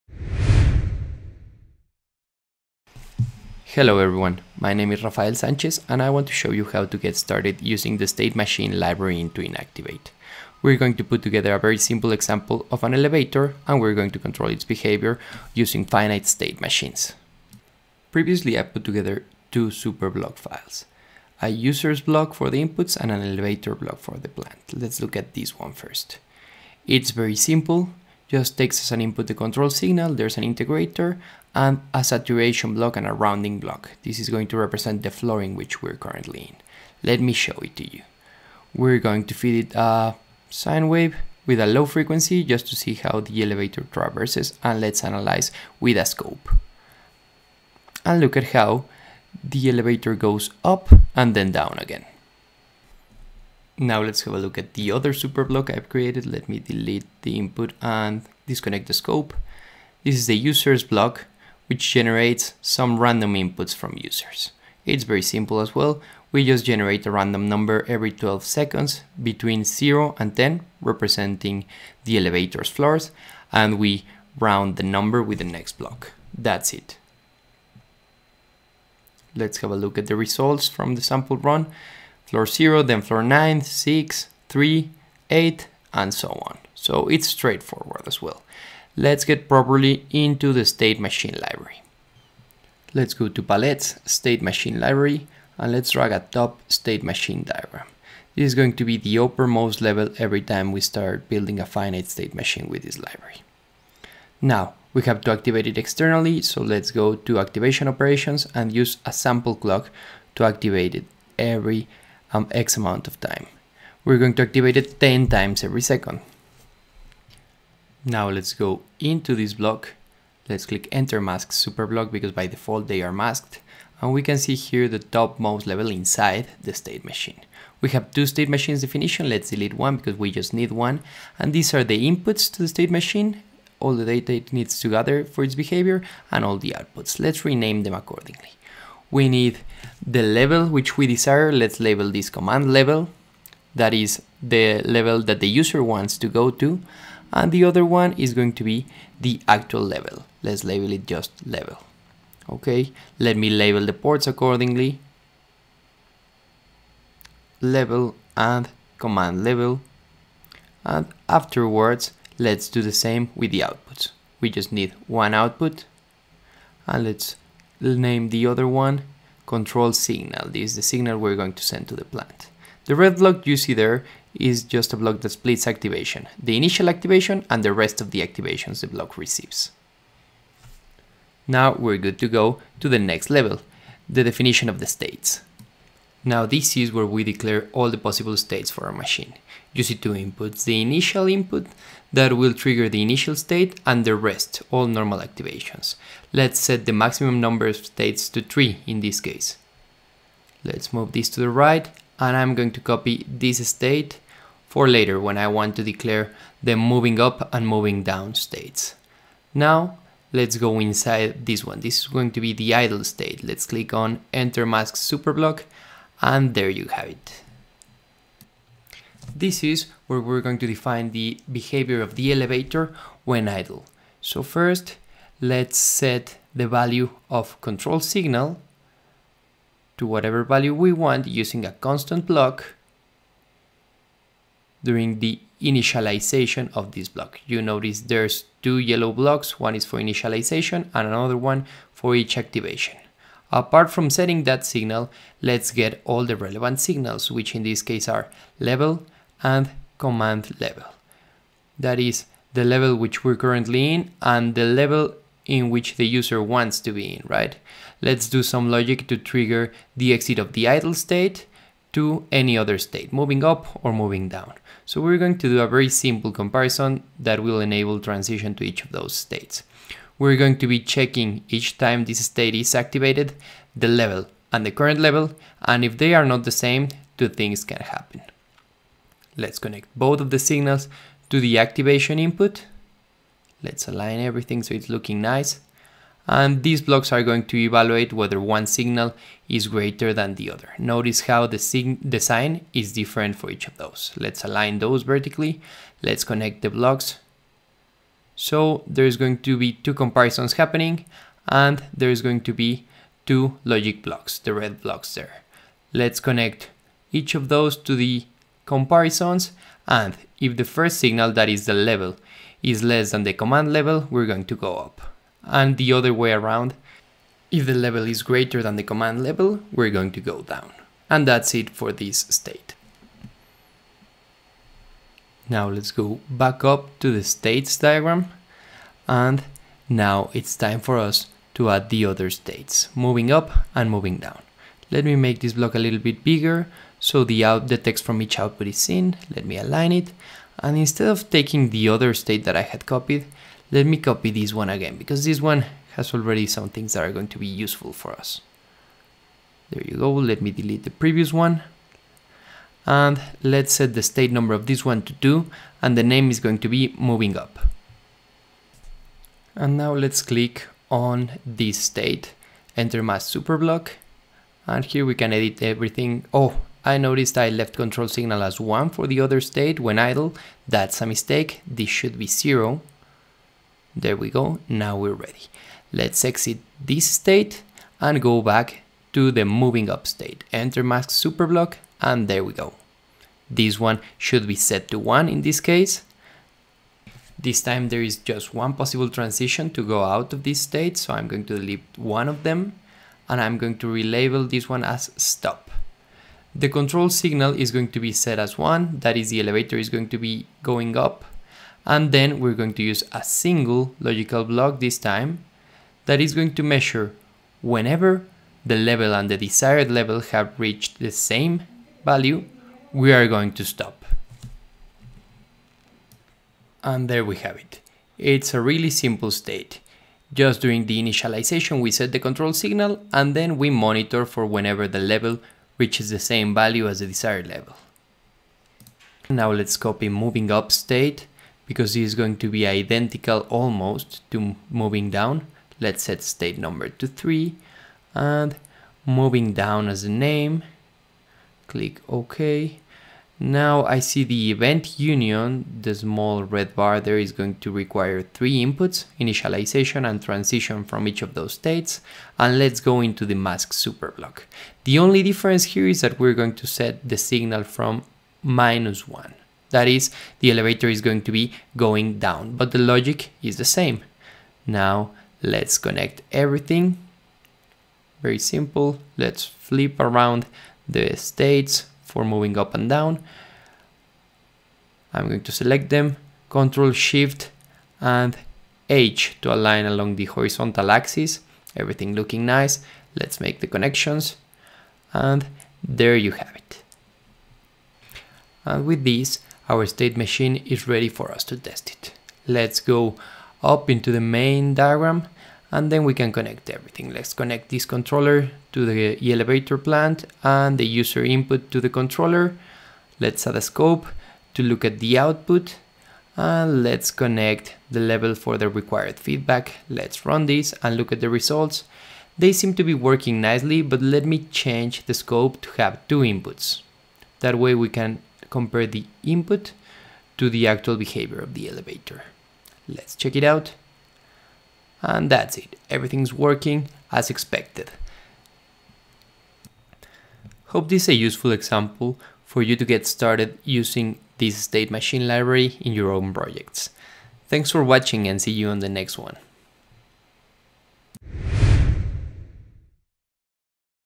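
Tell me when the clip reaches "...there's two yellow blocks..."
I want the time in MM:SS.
03:58.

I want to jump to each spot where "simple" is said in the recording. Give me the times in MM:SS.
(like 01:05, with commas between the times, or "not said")
00:11, 00:27, 01:05, 04:25, 06:58, 07:48.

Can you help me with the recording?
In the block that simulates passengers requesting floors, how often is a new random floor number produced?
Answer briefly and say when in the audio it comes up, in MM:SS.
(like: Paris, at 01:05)
Every 12 seconds, at 01:07.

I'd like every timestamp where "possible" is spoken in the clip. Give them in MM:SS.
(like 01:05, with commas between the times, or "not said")
03:07, 06:28.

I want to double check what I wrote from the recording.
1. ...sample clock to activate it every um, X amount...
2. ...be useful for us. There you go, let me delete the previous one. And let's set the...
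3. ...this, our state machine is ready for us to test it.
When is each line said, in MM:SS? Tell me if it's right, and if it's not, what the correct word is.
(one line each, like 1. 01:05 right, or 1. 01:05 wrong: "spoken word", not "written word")
1. 01:49 right
2. 05:47 right
3. 08:09 right.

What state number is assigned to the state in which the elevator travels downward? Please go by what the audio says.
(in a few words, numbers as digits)
3.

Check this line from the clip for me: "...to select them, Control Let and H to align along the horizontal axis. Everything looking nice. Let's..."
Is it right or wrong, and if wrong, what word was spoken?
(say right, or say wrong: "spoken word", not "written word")
wrong: "Shift", not "Let".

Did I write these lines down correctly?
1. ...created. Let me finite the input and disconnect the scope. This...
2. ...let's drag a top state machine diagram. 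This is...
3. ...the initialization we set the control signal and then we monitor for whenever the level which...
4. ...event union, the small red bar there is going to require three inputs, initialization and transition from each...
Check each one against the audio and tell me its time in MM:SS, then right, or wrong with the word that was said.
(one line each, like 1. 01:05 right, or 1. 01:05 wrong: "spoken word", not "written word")
1. 00:55 wrong: "delete", not "finite"
2. 01:35 right
3. 07:00 right
4. 07:24 right.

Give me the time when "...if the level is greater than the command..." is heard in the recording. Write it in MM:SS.
05:17.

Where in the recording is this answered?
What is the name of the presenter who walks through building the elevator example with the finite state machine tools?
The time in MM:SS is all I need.
00:05.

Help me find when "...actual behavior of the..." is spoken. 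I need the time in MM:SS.
08:40.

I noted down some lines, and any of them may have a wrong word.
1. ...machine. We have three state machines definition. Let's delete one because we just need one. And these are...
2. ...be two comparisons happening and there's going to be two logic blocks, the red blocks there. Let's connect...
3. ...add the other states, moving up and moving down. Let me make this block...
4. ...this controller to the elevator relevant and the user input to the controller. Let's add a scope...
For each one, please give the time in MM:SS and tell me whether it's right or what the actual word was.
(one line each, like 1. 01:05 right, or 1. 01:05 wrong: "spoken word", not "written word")
1. 02:07 wrong: "two", not "three"
2. 04:59 right
3. 05:31 right
4. 08:17 wrong: "plant", not "relevant".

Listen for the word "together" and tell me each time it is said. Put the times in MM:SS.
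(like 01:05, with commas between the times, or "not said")
00:11, 00:18.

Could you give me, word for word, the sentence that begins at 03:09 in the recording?
You see two inputs, the initial input that will trigger the initial state and the rest, all normal activations.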